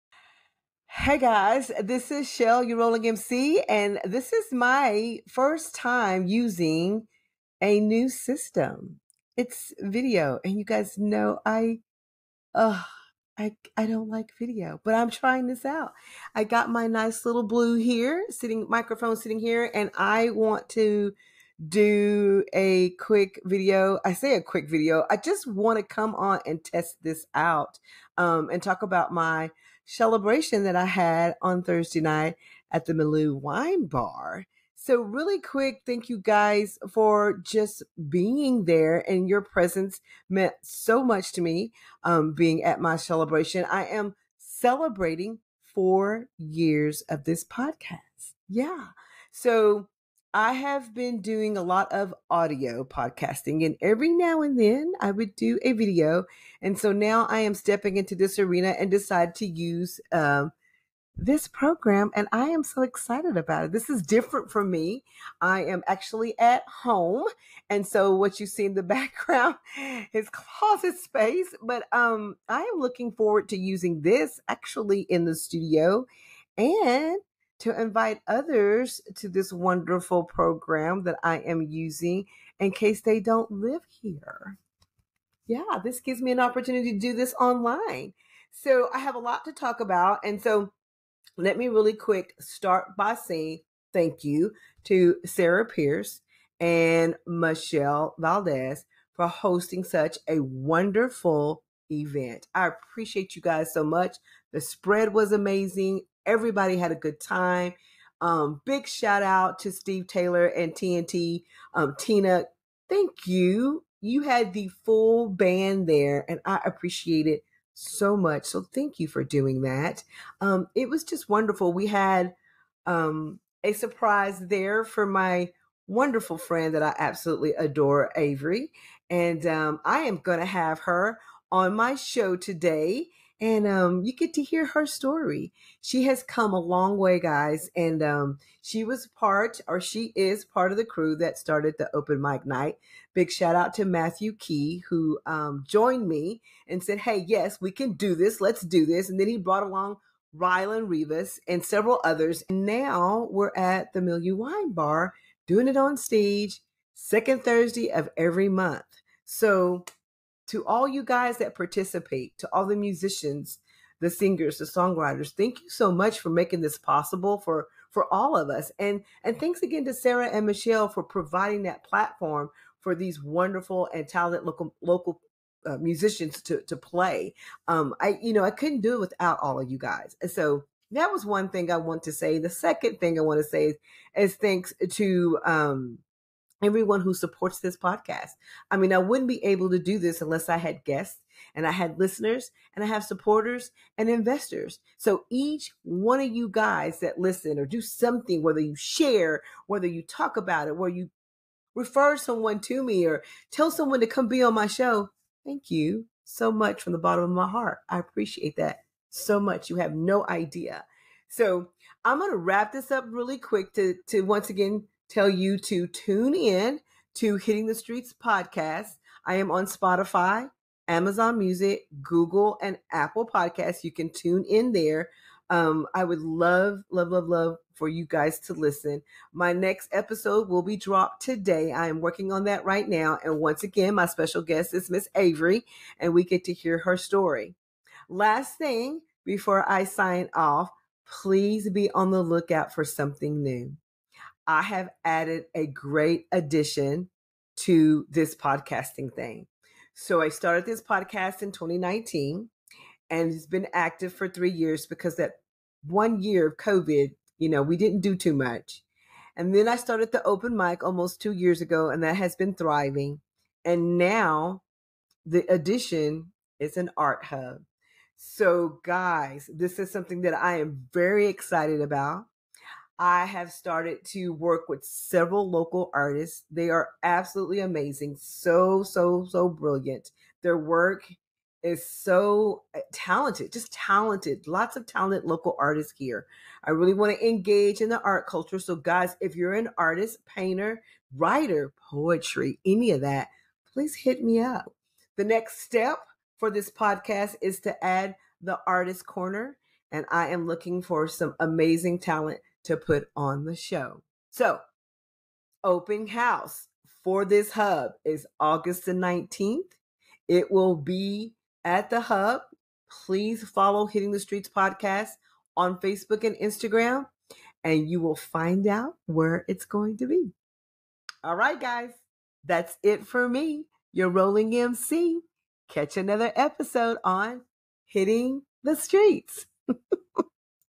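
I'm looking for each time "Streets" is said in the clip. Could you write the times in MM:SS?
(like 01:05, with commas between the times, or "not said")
03:37, 05:14, 05:28.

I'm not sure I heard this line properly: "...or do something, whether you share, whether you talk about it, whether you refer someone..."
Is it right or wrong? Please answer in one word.
right.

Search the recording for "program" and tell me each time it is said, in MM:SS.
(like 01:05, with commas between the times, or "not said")
01:01, 01:20.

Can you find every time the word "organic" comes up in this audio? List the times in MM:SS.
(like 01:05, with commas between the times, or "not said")
not said.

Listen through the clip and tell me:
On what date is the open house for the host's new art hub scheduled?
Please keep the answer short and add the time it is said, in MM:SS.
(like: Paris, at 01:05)
August 19, at 05:08.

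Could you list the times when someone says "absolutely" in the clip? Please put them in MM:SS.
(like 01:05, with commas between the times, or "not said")
02:06, 04:37.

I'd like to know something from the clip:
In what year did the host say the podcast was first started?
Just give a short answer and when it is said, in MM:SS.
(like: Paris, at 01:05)
2019, at 04:11.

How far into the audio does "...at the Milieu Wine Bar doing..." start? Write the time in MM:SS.
02:33.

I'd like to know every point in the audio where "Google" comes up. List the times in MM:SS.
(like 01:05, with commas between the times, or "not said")
03:42.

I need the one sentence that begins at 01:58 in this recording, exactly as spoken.
So thank you for doing that.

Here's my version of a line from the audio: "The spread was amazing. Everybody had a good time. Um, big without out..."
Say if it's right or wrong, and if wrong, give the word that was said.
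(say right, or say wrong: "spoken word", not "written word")
wrong: "shout", not "without".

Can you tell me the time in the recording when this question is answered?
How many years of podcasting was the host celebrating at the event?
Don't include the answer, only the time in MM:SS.
00:45.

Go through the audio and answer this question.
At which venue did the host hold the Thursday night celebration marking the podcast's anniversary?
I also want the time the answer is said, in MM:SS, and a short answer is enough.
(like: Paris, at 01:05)
Malou Wine Bar, at 00:32.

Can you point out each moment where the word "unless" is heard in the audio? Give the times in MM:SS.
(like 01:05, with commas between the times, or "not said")
03:10.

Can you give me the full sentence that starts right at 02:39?
So to all you guys that participate, to all the musicians, the singers, the songwriters.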